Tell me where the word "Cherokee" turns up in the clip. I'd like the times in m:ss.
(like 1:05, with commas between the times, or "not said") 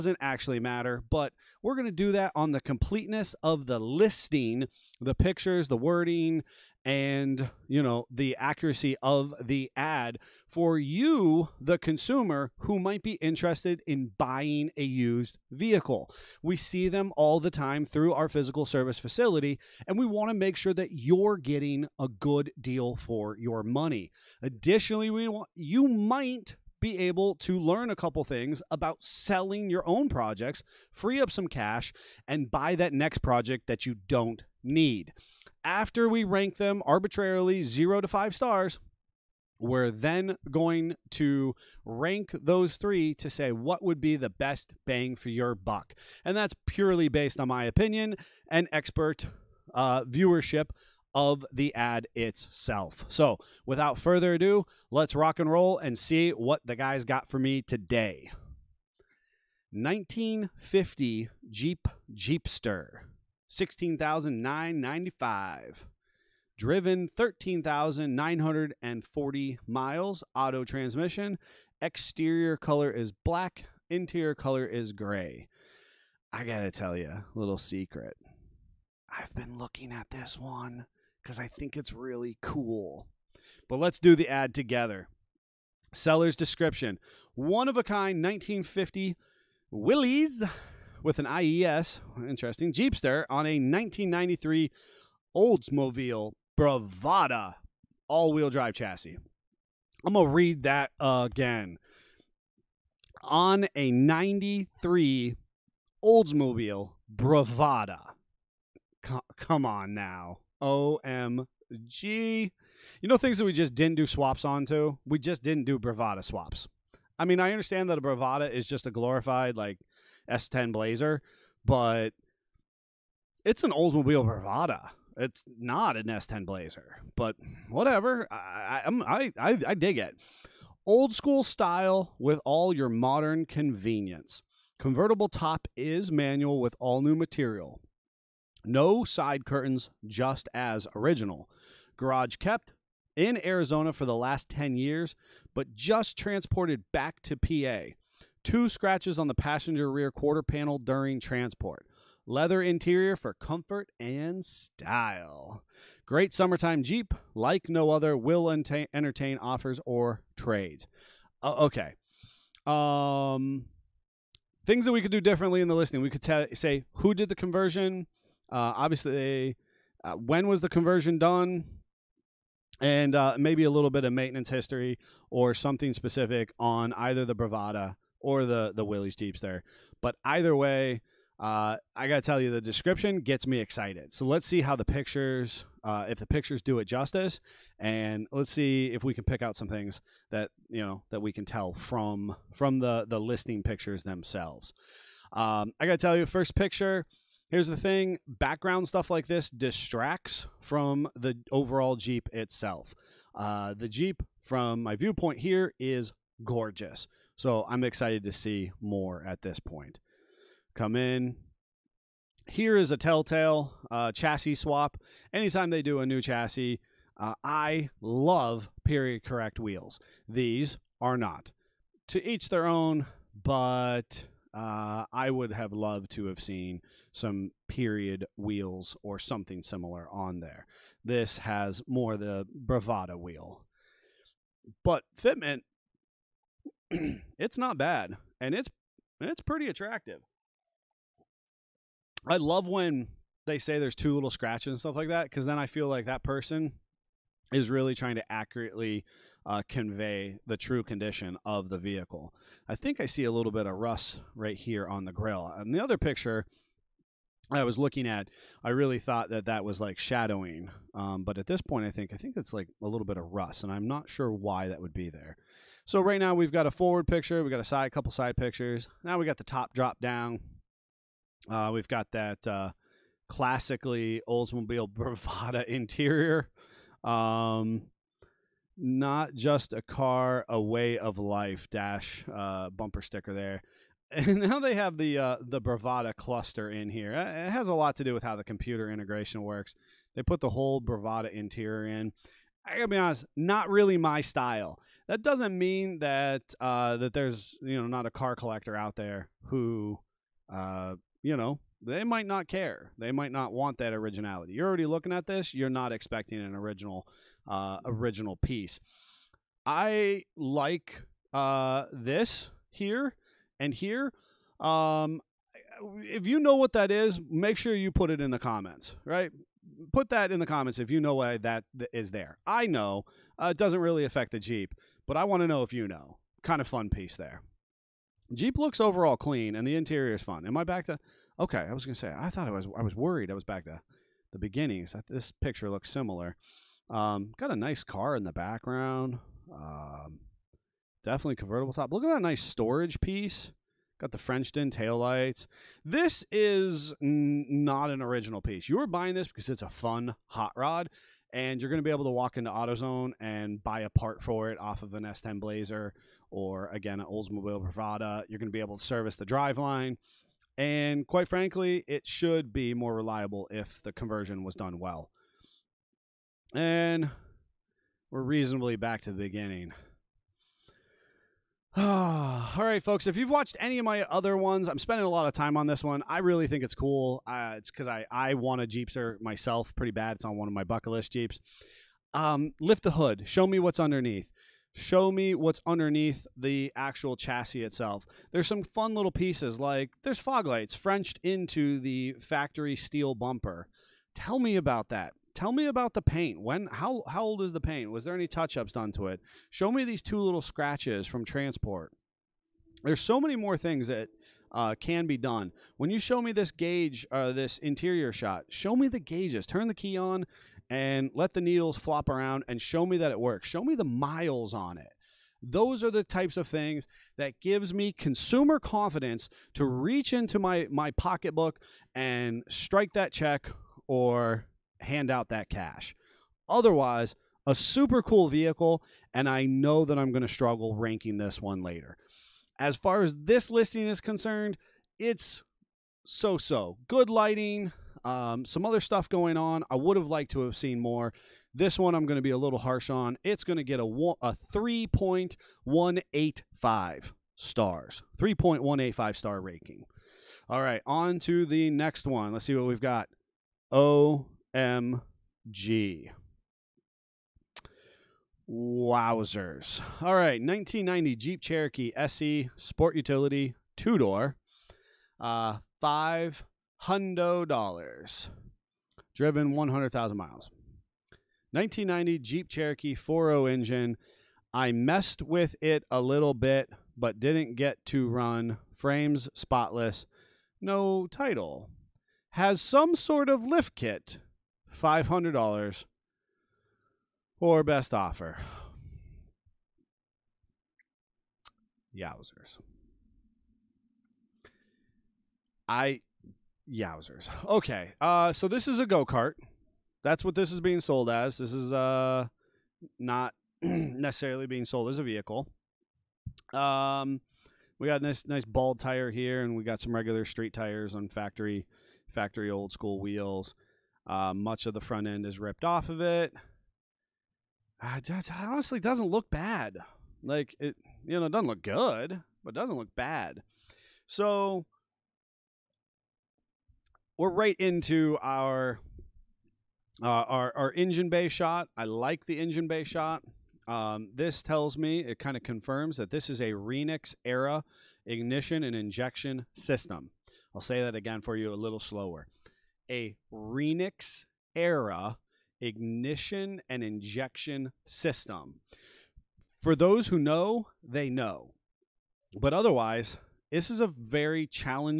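7:41, 7:52.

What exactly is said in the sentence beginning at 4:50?
They put the whole Bravada interior in.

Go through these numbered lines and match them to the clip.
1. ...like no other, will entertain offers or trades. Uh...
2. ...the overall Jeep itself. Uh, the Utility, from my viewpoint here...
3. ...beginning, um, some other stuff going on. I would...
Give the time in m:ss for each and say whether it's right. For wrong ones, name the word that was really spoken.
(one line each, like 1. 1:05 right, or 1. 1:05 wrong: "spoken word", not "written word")
1. 2:37 right
2. 3:21 wrong: "Jeep", not "Utility"
3. 7:17 wrong: "lighting", not "beginning".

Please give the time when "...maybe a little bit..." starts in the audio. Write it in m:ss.
2:53.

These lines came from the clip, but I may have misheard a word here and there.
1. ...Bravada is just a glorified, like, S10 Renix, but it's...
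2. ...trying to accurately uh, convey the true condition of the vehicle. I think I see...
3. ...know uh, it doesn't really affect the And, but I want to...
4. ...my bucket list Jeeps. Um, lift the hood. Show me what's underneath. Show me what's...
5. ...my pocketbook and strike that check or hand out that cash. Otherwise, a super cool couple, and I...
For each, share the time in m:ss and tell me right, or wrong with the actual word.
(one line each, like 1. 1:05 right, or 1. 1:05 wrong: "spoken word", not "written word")
1. 1:58 wrong: "Blazer", not "Renix"
2. 4:07 right
3. 5:22 wrong: "Jeep", not "And"
4. 6:20 right
5. 7:00 wrong: "vehicle", not "couple".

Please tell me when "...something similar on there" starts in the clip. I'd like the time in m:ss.
3:49.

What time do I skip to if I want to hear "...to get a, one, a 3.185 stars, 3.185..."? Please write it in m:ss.
7:23.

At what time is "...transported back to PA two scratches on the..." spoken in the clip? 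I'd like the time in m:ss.
2:26.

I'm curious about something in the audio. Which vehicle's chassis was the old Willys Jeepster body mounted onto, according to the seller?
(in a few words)
1993 Oldsmobile Bravada.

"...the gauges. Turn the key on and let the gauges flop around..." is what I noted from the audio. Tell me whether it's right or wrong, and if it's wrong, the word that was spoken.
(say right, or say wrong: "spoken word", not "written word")
wrong: "needles", not "gauges".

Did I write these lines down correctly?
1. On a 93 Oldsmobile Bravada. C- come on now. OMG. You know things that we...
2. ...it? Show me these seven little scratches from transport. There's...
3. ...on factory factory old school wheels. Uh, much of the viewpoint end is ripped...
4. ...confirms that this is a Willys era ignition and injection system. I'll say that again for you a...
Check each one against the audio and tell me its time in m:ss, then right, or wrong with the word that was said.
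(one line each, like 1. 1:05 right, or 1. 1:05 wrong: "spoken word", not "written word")
1. 1:43 right
2. 6:39 wrong: "two", not "seven"
3. 8:30 wrong: "front", not "viewpoint"
4. 8:55 wrong: "Renix", not "Willys".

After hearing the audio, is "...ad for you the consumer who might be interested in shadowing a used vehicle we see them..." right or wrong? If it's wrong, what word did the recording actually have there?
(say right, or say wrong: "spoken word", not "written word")
wrong: "buying", not "shadowing".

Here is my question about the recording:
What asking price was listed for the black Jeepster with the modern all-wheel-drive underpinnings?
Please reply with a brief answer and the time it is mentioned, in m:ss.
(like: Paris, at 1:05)
$16,995, at 1:03.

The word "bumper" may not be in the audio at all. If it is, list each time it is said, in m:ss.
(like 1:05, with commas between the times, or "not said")
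4:42, 6:33.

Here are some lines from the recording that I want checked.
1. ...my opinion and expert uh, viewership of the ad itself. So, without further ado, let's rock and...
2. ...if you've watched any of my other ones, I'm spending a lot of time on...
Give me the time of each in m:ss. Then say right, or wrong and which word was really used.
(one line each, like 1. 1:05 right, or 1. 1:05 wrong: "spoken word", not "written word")
1. 0:47 right
2. 6:13 right.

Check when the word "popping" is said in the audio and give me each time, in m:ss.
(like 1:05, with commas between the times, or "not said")
not said.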